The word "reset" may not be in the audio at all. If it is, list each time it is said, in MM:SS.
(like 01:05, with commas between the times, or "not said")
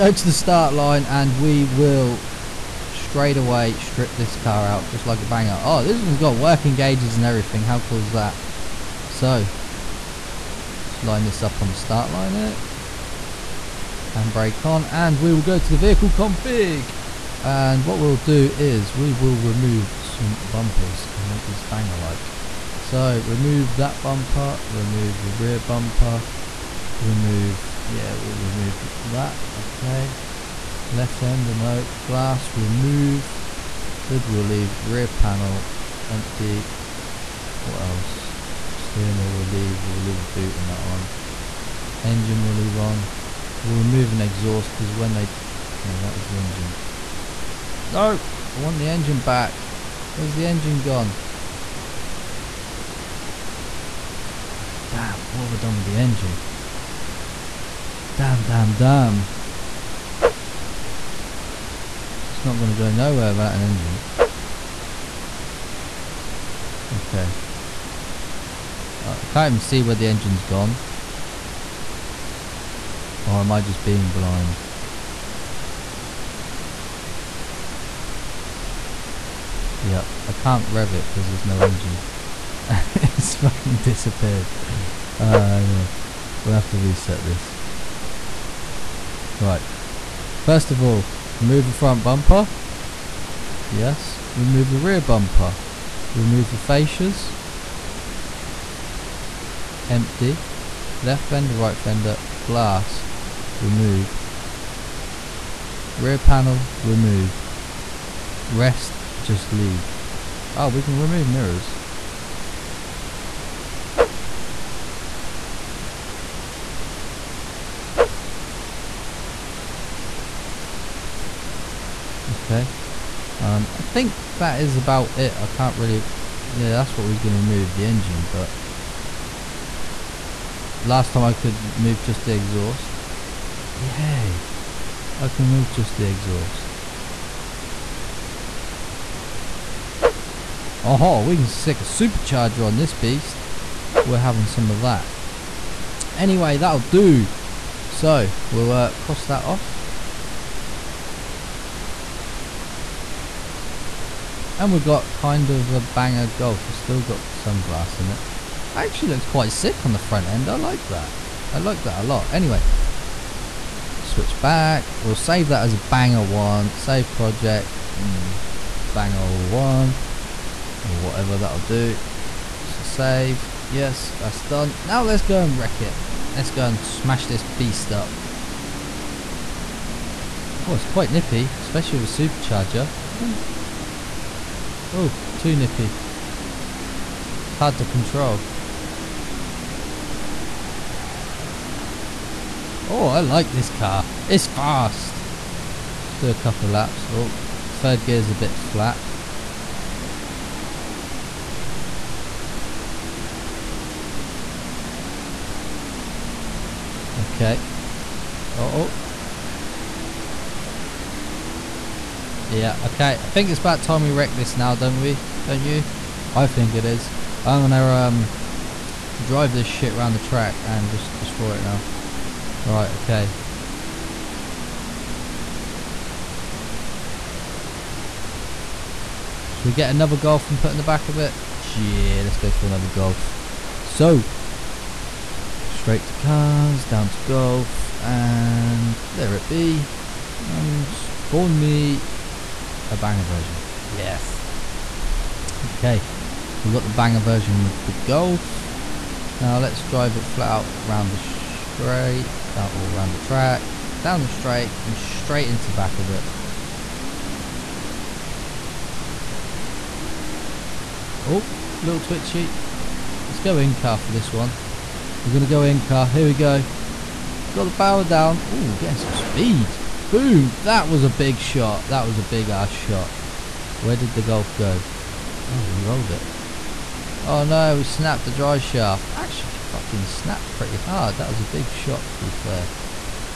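01:26.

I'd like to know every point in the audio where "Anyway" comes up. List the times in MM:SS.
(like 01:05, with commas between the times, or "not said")
02:26, 02:42.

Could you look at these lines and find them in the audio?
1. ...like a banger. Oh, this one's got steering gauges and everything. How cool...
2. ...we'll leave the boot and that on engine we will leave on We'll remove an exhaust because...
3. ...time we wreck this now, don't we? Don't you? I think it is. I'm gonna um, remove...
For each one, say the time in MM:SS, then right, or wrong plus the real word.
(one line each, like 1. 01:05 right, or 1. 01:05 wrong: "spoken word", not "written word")
1. 00:05 wrong: "working", not "steering"
2. 00:39 right
3. 03:33 wrong: "drive", not "remove".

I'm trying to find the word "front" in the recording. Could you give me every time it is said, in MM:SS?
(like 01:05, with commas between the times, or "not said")
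01:31, 02:40.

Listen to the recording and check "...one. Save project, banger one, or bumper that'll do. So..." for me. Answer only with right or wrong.
wrong.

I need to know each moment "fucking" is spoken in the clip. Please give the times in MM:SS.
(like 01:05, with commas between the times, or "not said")
01:23, 04:39.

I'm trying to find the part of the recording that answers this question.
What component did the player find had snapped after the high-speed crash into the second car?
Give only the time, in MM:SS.
04:38.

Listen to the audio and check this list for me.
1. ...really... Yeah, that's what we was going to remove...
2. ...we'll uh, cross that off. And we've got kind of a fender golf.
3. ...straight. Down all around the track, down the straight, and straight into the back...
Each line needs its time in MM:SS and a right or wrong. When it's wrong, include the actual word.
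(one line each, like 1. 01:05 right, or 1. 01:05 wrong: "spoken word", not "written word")
1. 02:05 right
2. 02:28 wrong: "banger", not "fender"
3. 04:11 right.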